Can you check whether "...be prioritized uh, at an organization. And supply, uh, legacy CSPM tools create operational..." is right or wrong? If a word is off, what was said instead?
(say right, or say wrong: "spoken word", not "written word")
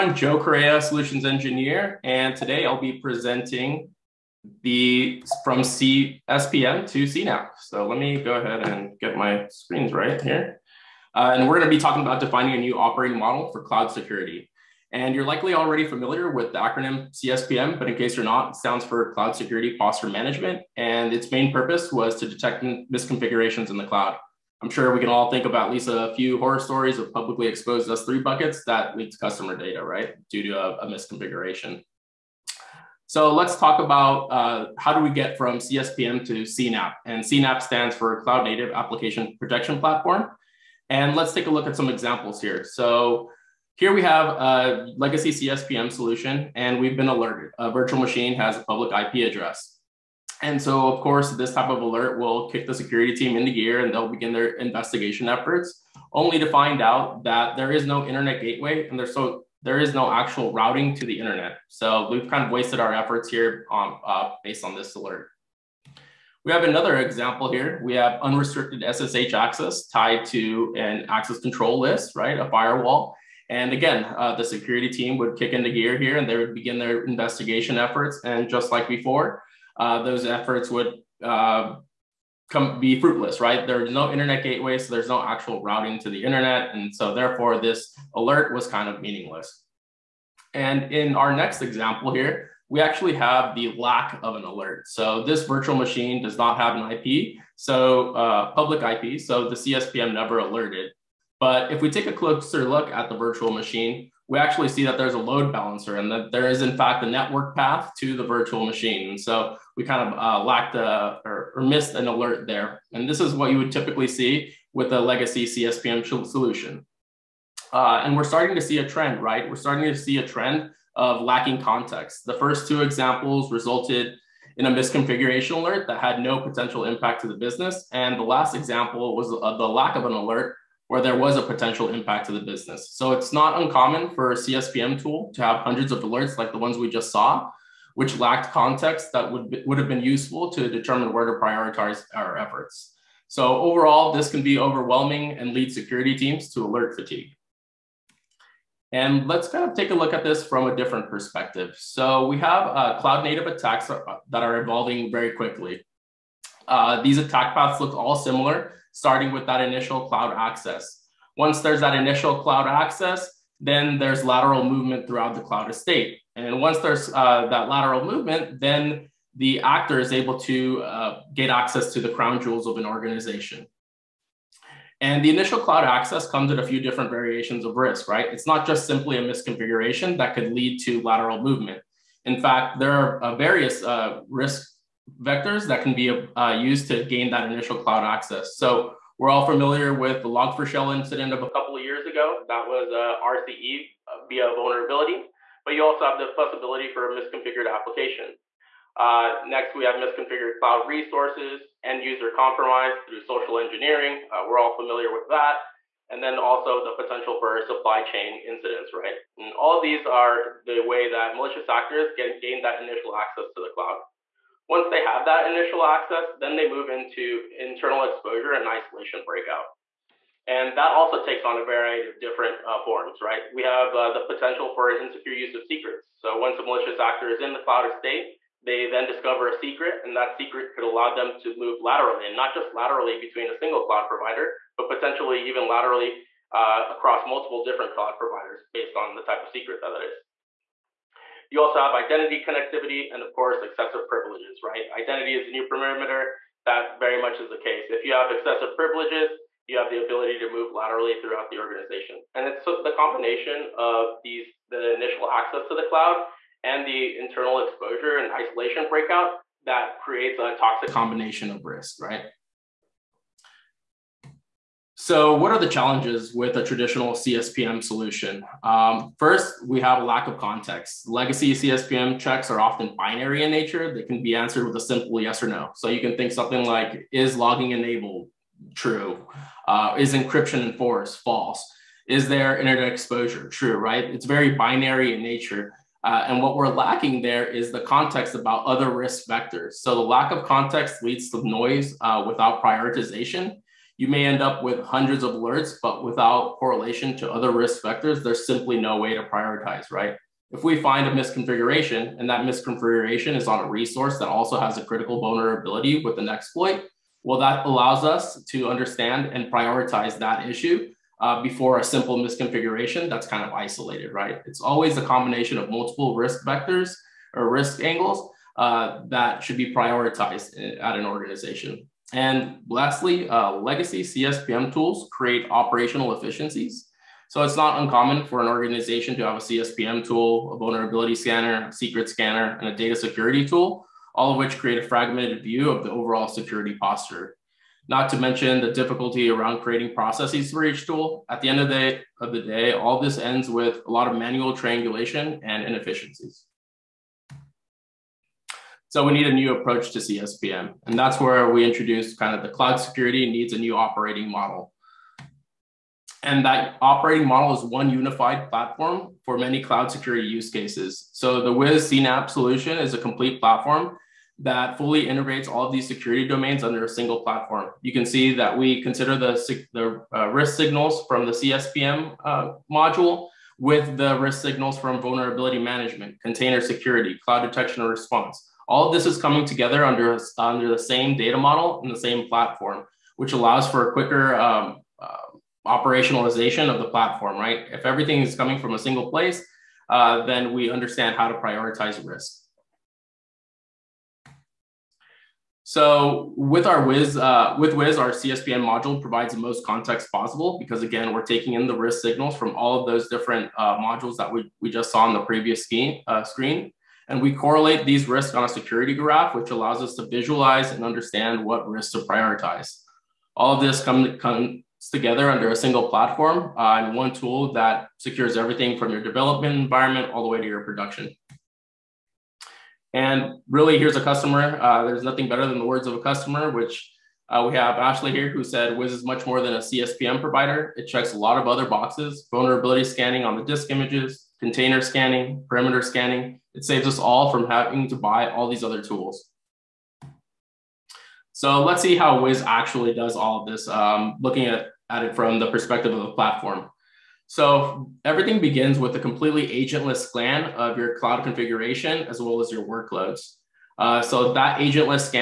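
wrong: "lastly", not "supply".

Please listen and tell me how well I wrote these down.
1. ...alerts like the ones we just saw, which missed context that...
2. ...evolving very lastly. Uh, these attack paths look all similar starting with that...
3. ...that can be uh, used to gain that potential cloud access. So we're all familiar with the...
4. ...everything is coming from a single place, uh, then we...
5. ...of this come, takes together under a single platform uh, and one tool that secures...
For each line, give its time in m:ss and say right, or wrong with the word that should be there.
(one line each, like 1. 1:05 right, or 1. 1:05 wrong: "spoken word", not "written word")
1. 2:16 wrong: "lacked", not "missed"
2. 2:34 wrong: "quickly", not "lastly"
3. 3:05 wrong: "initial", not "potential"
4. 6:27 right
5. 6:53 wrong: "comes", not "takes".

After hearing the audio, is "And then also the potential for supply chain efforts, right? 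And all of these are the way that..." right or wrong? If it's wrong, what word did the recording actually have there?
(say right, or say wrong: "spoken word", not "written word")
wrong: "incidents", not "efforts".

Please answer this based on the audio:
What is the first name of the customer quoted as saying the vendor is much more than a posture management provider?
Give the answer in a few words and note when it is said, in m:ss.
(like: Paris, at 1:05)
Ashley, at 7:07.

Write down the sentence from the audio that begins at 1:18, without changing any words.
And just like before, uh, those efforts would uh, come be fruitless, right?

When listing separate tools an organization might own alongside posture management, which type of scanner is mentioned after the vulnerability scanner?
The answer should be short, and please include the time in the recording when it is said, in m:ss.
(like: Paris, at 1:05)
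secret scanner, at 5:31.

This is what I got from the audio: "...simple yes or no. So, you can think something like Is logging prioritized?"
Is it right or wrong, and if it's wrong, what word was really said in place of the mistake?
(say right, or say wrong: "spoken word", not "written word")
wrong: "enabled", not "prioritized".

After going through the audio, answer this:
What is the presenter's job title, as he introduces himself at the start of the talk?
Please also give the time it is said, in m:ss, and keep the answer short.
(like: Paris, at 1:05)
Solutions Engineer, at 0:00.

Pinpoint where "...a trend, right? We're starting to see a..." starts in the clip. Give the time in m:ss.
1:58.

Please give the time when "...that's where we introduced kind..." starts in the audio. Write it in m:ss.
5:50.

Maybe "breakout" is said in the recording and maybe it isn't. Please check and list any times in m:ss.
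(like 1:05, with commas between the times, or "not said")
3:39, 4:18.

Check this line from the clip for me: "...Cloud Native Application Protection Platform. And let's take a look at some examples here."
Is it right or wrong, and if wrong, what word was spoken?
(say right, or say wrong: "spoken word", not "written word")
right.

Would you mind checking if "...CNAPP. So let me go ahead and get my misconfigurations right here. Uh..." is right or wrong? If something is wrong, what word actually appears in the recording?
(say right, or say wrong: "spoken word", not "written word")
wrong: "screens", not "misconfigurations".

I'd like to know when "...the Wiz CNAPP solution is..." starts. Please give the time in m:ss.
6:01.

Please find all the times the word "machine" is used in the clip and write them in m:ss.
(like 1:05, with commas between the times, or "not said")
0:47, 1:35, 1:43, 1:48.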